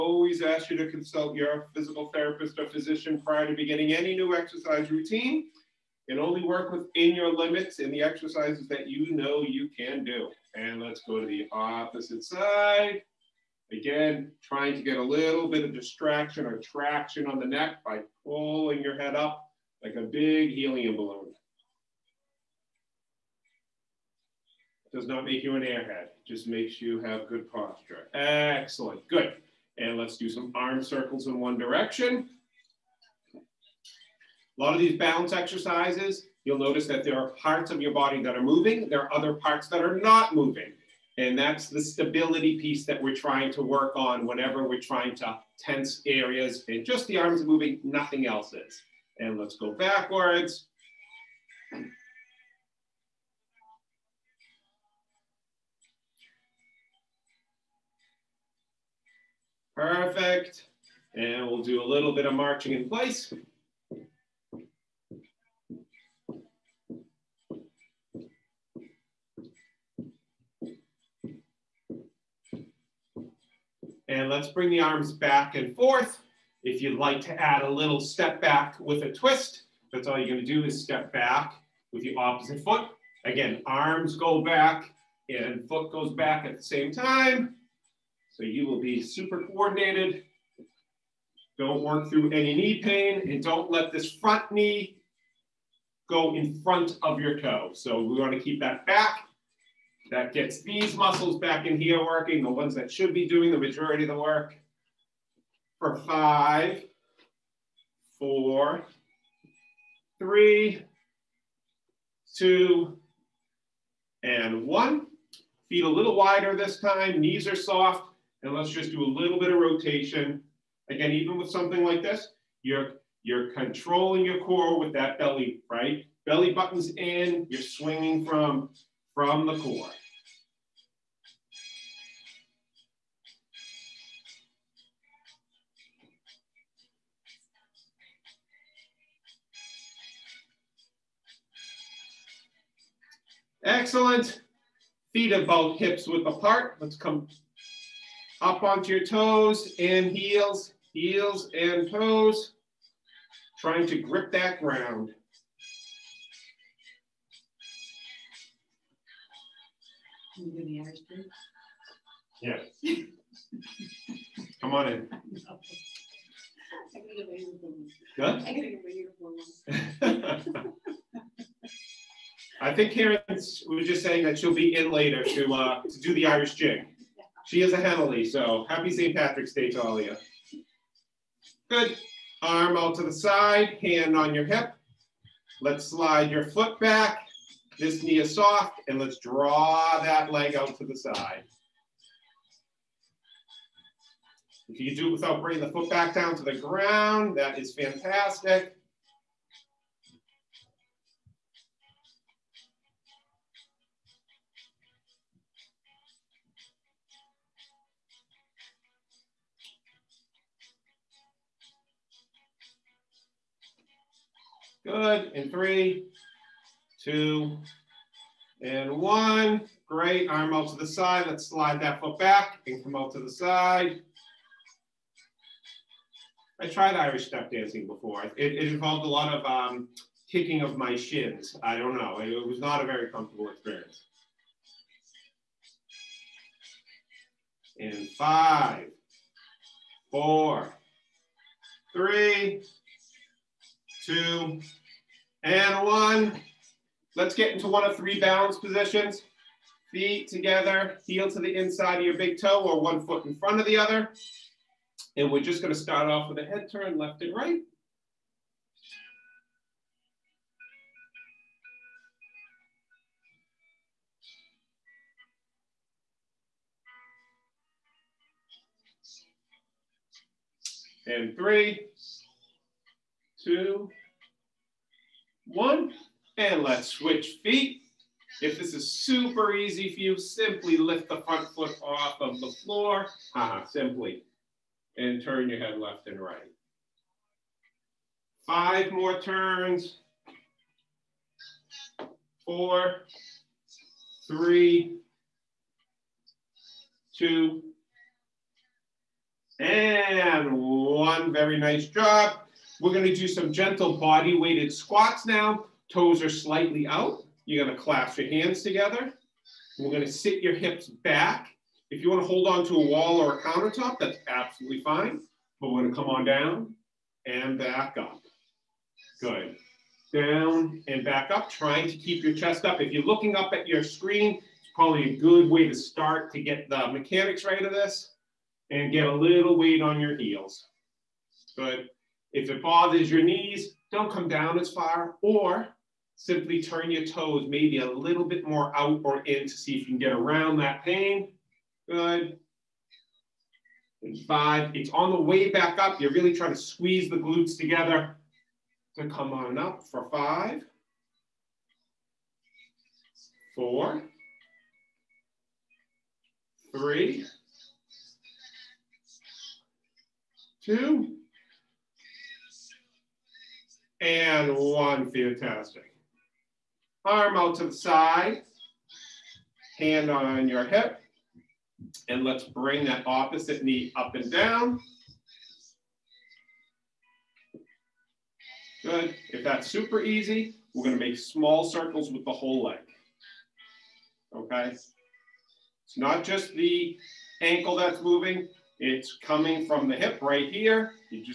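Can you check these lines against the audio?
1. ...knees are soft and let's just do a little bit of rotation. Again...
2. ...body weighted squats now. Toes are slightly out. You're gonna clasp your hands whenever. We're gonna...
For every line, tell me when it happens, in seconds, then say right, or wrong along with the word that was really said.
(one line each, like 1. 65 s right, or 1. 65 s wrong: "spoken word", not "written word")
1. 117 s right
2. 303 s wrong: "together", not "whenever".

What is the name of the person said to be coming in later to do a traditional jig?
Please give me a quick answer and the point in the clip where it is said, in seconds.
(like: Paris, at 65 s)
Karen, at 172 s.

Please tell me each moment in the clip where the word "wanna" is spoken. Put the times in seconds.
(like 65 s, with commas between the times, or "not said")
98 s, 312 s.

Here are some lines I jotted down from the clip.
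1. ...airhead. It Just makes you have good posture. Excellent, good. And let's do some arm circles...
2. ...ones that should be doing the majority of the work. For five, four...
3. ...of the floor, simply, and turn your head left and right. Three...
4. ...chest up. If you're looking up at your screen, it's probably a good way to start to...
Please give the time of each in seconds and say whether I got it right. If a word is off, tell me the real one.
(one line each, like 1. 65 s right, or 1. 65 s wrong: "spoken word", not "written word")
1. 25 s right
2. 102 s right
3. 282 s wrong: "Five", not "Three"
4. 322 s right.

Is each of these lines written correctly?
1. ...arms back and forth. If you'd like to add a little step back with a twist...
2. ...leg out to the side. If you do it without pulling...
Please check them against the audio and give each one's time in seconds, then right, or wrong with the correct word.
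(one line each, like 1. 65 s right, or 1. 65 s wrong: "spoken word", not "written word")
1. 74 s right
2. 190 s wrong: "bringing", not "pulling".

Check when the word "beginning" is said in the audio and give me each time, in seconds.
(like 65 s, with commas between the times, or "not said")
3 s.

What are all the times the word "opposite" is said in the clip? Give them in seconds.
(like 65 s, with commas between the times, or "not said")
11 s, 82 s, 373 s.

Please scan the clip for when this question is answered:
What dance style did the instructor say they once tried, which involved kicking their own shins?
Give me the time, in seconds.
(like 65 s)
226 s.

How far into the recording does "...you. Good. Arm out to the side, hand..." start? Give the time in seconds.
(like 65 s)
180 s.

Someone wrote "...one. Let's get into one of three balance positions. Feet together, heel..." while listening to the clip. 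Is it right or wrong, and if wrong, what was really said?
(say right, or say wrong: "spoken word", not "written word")
right.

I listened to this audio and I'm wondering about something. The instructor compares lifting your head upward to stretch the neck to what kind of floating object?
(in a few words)
helium balloon.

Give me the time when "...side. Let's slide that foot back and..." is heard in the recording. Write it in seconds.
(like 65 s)
220 s.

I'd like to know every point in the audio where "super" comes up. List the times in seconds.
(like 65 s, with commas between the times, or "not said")
89 s, 278 s, 379 s.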